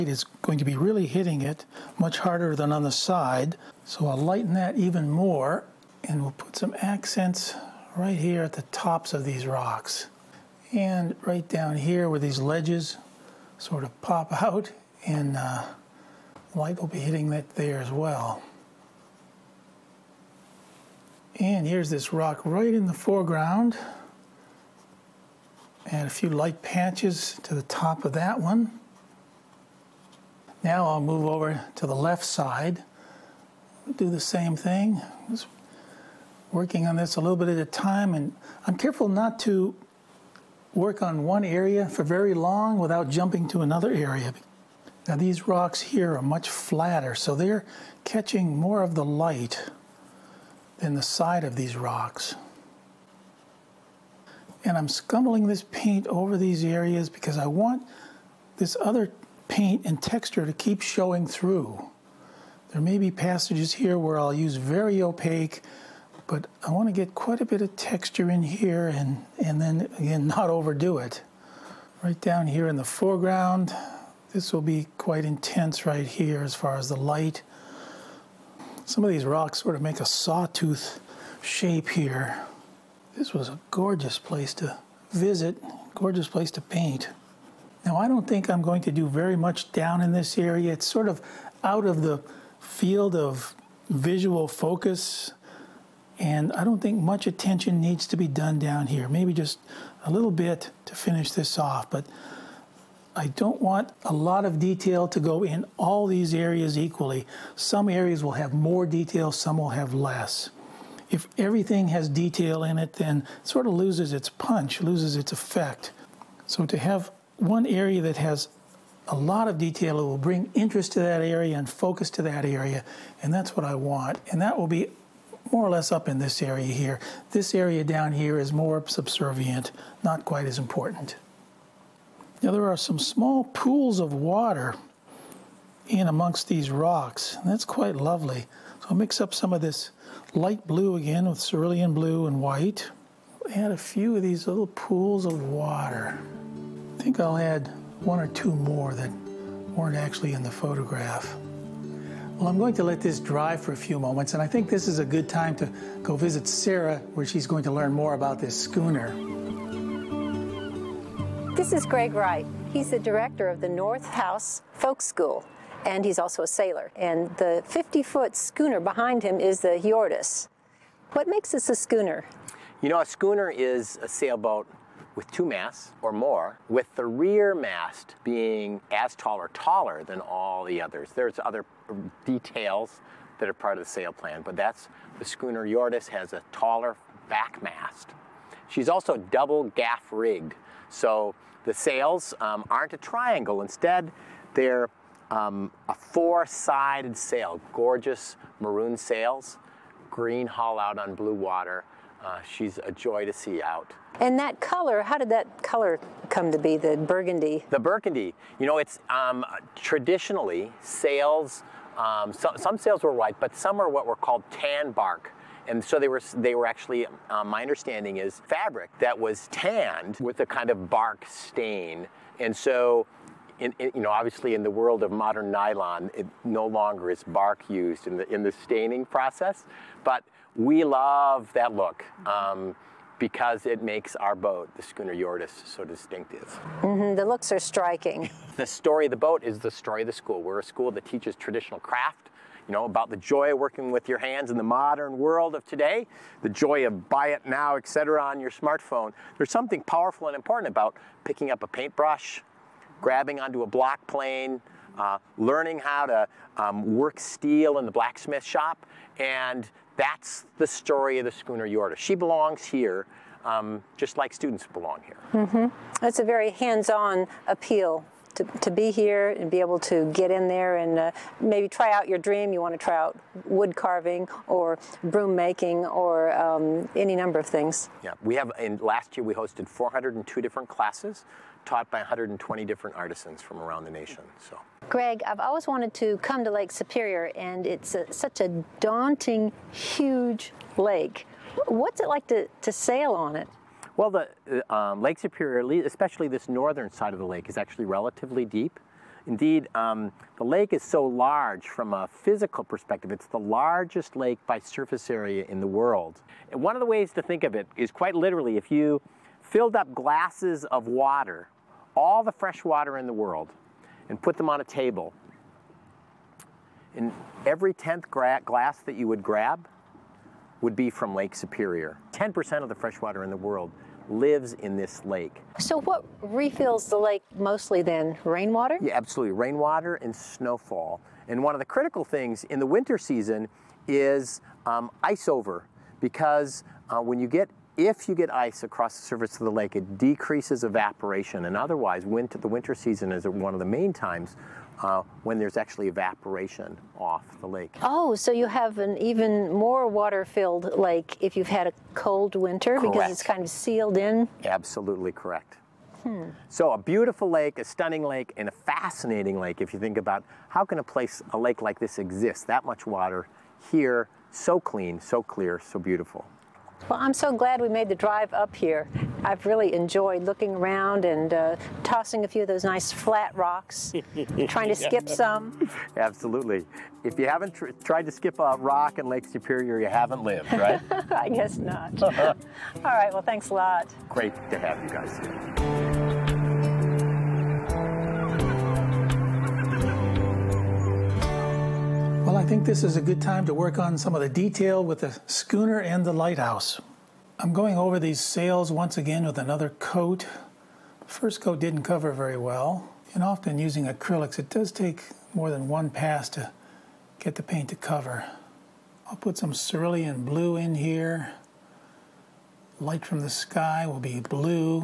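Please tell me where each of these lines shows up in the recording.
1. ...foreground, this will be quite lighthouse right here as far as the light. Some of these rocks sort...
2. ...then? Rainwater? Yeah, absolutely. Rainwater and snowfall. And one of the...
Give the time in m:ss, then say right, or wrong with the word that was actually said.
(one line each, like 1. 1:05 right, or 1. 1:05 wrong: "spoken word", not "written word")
1. 1:12 wrong: "intense", not "lighthouse"
2. 5:27 right.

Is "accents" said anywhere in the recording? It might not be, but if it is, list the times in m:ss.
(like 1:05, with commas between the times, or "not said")
0:06.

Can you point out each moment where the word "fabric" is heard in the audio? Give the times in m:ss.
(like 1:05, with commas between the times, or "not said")
3:38.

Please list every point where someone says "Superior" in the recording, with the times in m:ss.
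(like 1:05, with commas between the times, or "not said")
4:46, 4:55, 5:21, 6:19.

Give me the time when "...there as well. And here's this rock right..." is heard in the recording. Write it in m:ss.
0:17.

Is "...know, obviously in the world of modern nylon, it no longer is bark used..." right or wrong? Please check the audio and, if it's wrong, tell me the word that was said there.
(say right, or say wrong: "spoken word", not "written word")
right.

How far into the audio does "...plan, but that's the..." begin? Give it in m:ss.
3:04.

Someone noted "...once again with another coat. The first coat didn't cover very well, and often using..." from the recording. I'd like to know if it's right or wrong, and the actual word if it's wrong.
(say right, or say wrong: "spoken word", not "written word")
right.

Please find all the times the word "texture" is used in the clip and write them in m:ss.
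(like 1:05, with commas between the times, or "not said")
1:00, 1:07.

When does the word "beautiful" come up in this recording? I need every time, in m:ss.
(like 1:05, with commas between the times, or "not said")
5:56, 6:05.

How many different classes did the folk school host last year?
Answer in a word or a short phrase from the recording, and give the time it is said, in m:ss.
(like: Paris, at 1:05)
402, at 4:39.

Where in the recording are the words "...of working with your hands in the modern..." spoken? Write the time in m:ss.
4:03.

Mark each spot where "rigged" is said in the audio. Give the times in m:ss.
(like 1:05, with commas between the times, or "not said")
3:10.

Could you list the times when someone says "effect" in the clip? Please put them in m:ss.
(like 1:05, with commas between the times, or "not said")
1:55.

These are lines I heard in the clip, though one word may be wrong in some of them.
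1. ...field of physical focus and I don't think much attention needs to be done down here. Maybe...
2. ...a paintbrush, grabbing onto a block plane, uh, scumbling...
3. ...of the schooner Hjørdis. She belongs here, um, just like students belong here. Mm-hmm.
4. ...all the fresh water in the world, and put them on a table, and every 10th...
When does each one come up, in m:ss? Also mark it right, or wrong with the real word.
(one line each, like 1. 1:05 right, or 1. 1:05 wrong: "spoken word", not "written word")
1. 1:32 wrong: "visual", not "physical"
2. 4:11 wrong: "learning", not "scumbling"
3. 4:21 right
4. 5:11 right.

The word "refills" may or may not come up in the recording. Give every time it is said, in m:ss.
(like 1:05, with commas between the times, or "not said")
5:26.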